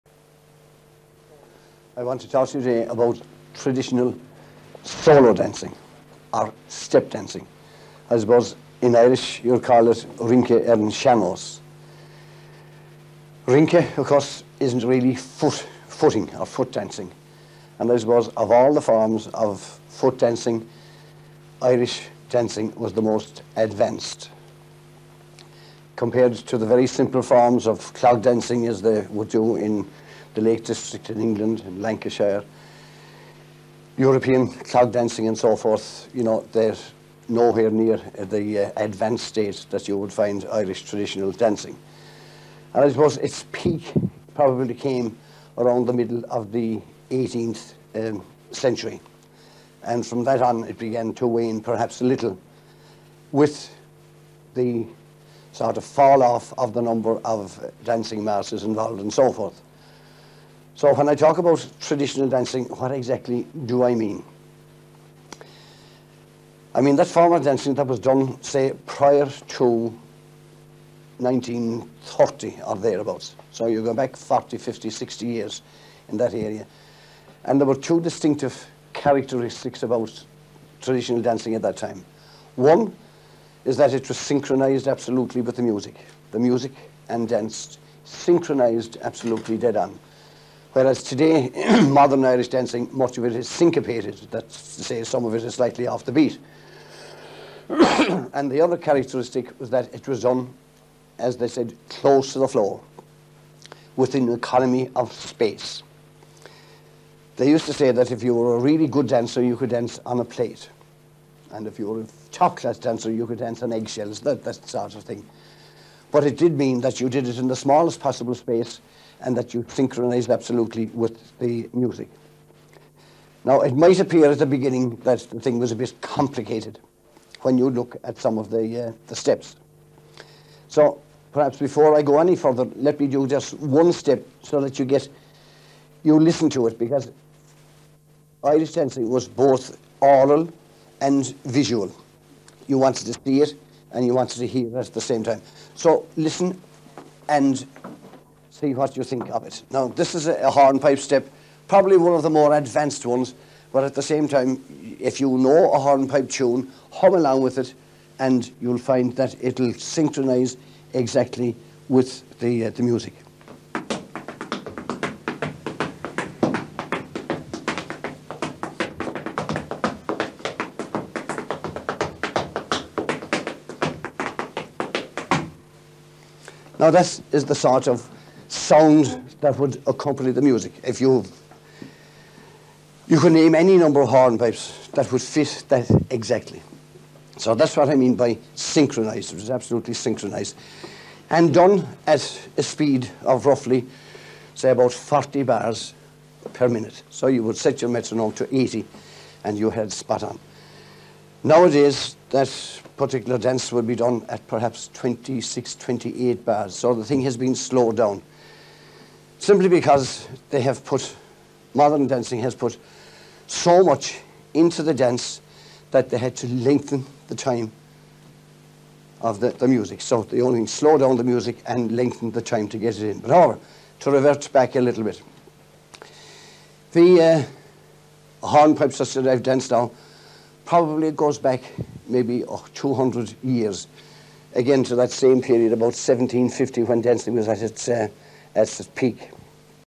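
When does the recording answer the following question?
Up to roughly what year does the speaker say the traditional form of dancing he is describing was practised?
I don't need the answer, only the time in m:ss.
1:11.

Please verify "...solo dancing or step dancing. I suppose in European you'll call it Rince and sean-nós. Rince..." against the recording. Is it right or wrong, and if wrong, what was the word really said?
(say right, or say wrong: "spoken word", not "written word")
wrong: "Irish", not "European".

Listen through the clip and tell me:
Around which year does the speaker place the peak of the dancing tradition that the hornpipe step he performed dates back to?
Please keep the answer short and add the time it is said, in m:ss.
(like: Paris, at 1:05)
1750, at 3:55.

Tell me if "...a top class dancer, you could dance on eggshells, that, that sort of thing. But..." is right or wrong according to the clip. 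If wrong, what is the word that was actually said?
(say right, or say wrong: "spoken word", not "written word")
right.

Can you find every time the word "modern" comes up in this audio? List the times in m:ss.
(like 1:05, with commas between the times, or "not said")
1:31, 3:31.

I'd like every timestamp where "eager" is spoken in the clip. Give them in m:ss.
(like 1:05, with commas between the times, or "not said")
not said.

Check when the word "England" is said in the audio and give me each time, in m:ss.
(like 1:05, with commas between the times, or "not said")
0:31.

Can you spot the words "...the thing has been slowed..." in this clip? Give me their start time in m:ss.
3:26.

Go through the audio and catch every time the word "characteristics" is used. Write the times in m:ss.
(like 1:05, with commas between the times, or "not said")
1:18, 1:38.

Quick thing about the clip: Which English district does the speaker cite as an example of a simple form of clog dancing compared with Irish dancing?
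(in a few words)
Lake District.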